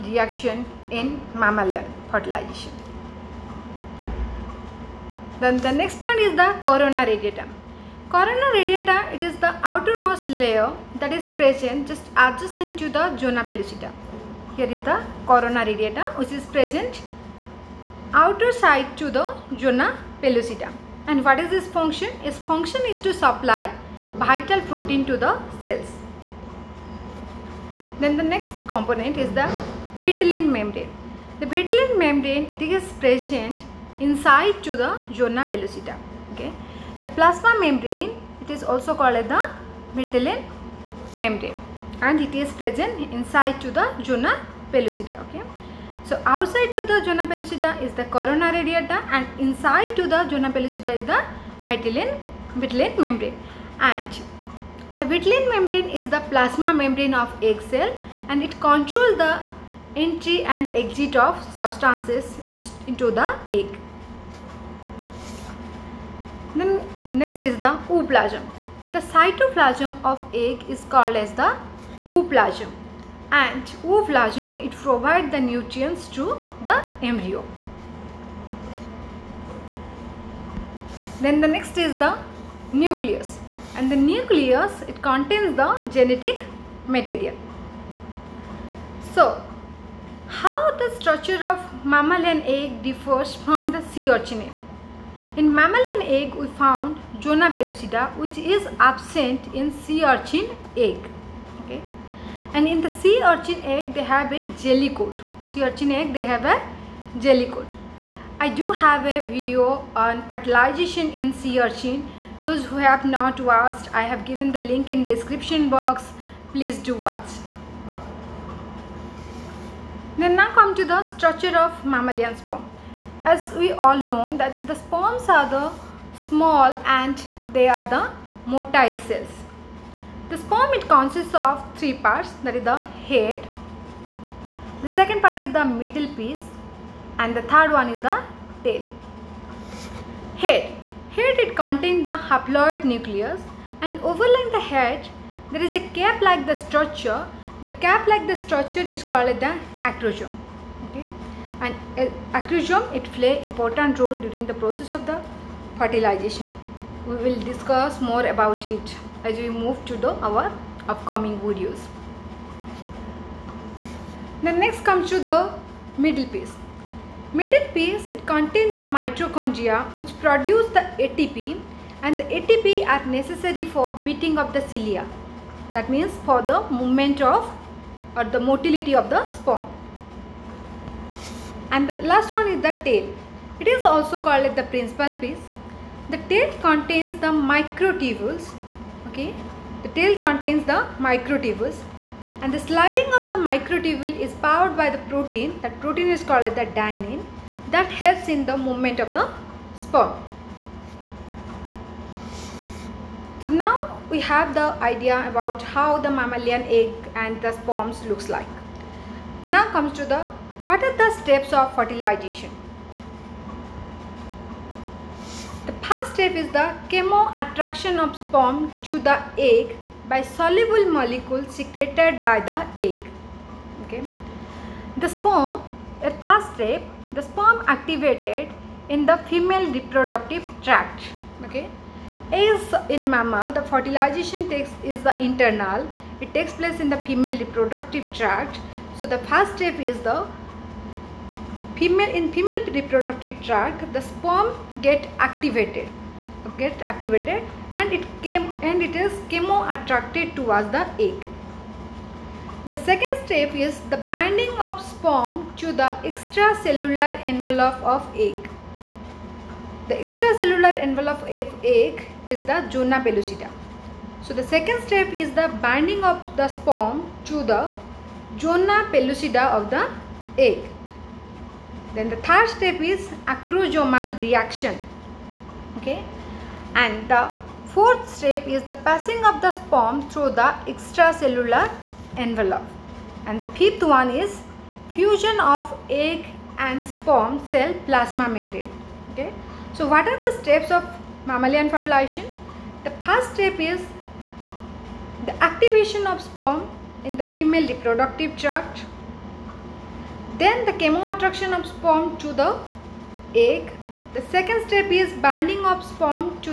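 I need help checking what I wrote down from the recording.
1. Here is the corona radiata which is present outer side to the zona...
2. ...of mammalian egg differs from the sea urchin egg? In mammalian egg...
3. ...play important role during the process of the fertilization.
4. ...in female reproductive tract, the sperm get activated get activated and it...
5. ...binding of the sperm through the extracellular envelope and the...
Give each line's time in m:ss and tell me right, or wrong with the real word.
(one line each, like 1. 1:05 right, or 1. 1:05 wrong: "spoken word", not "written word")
1. 0:14 right
2. 1:31 right
3. 2:33 right
4. 4:02 right
5. 4:38 wrong: "passing", not "binding".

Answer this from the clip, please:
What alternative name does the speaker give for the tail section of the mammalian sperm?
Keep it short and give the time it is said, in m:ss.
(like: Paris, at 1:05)
Principal piece, at 3:04.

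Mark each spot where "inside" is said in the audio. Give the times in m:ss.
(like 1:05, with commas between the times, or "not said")
0:33, 0:43, 0:49.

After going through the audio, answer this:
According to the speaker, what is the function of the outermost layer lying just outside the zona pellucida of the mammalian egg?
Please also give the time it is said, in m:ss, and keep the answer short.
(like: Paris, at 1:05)
Supply vital protein, at 0:23.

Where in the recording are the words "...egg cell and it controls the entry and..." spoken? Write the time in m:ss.
0:57.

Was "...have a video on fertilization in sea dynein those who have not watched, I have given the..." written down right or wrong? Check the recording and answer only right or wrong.
wrong.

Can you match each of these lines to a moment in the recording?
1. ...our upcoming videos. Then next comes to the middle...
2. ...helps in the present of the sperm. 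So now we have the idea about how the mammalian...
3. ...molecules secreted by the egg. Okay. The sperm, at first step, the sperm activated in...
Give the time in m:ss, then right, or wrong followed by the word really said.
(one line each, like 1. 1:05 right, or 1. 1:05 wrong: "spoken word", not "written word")
1. 2:40 right
2. 3:17 wrong: "movement", not "present"
3. 3:40 right.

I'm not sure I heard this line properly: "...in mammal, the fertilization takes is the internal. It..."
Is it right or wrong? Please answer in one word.
right.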